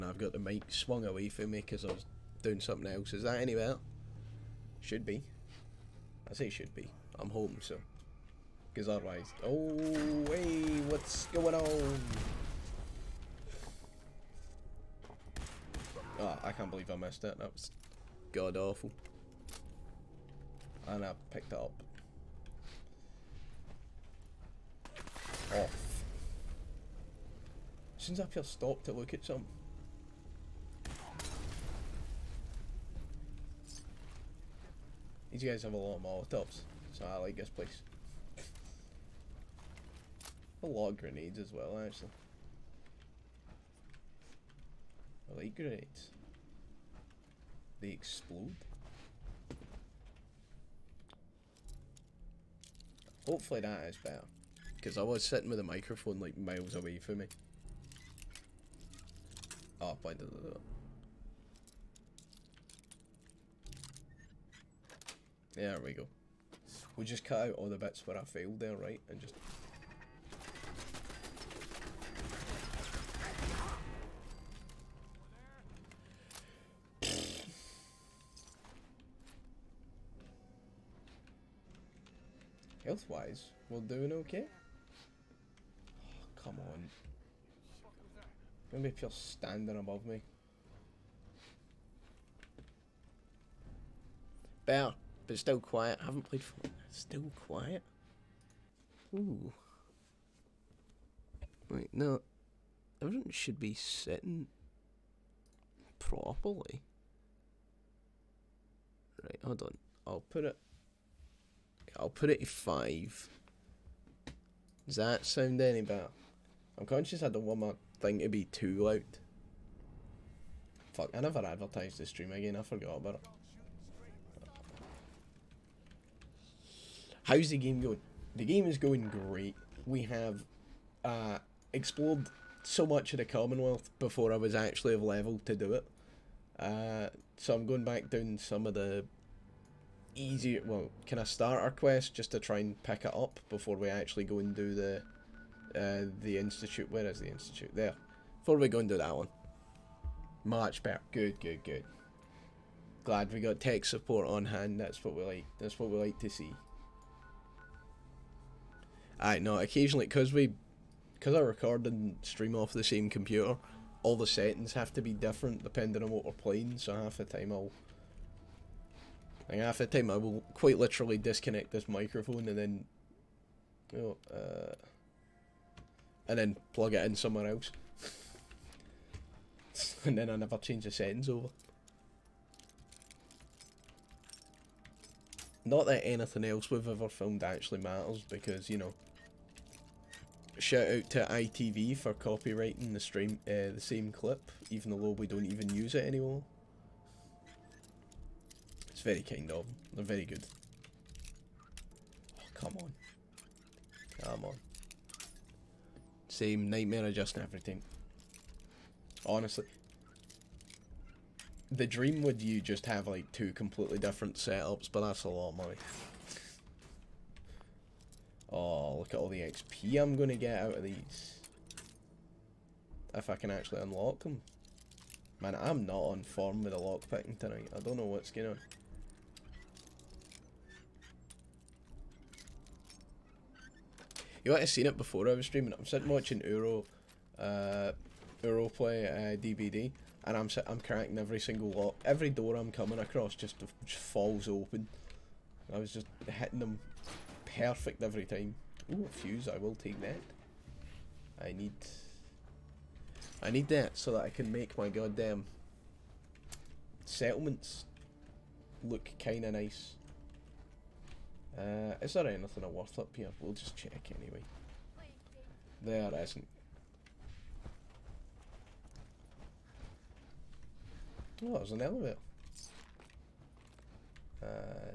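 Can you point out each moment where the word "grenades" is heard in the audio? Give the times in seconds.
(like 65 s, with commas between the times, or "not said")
40 s, 45 s.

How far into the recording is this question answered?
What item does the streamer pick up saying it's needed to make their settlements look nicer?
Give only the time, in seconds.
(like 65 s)
249 s.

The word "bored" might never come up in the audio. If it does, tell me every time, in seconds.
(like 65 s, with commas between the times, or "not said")
not said.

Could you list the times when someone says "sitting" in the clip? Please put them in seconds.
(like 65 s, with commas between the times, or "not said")
55 s, 103 s, 235 s.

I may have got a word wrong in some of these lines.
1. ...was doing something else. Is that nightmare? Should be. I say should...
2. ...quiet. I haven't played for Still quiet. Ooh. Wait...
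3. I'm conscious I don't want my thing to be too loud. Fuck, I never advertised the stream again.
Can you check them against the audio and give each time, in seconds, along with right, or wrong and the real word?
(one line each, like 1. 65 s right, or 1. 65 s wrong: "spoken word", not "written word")
1. 1 s wrong: "anywhere", not "nightmare"
2. 95 s right
3. 116 s right.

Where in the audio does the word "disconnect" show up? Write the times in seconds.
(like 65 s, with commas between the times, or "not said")
171 s.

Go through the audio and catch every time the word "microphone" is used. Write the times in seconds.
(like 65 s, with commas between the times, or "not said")
55 s, 171 s.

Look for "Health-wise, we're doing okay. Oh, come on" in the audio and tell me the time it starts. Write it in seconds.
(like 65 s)
82 s.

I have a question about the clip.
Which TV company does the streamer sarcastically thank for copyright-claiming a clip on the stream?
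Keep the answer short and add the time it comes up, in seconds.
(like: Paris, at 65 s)
ITV, at 191 s.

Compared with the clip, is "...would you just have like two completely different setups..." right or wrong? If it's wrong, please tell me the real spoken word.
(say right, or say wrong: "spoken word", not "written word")
right.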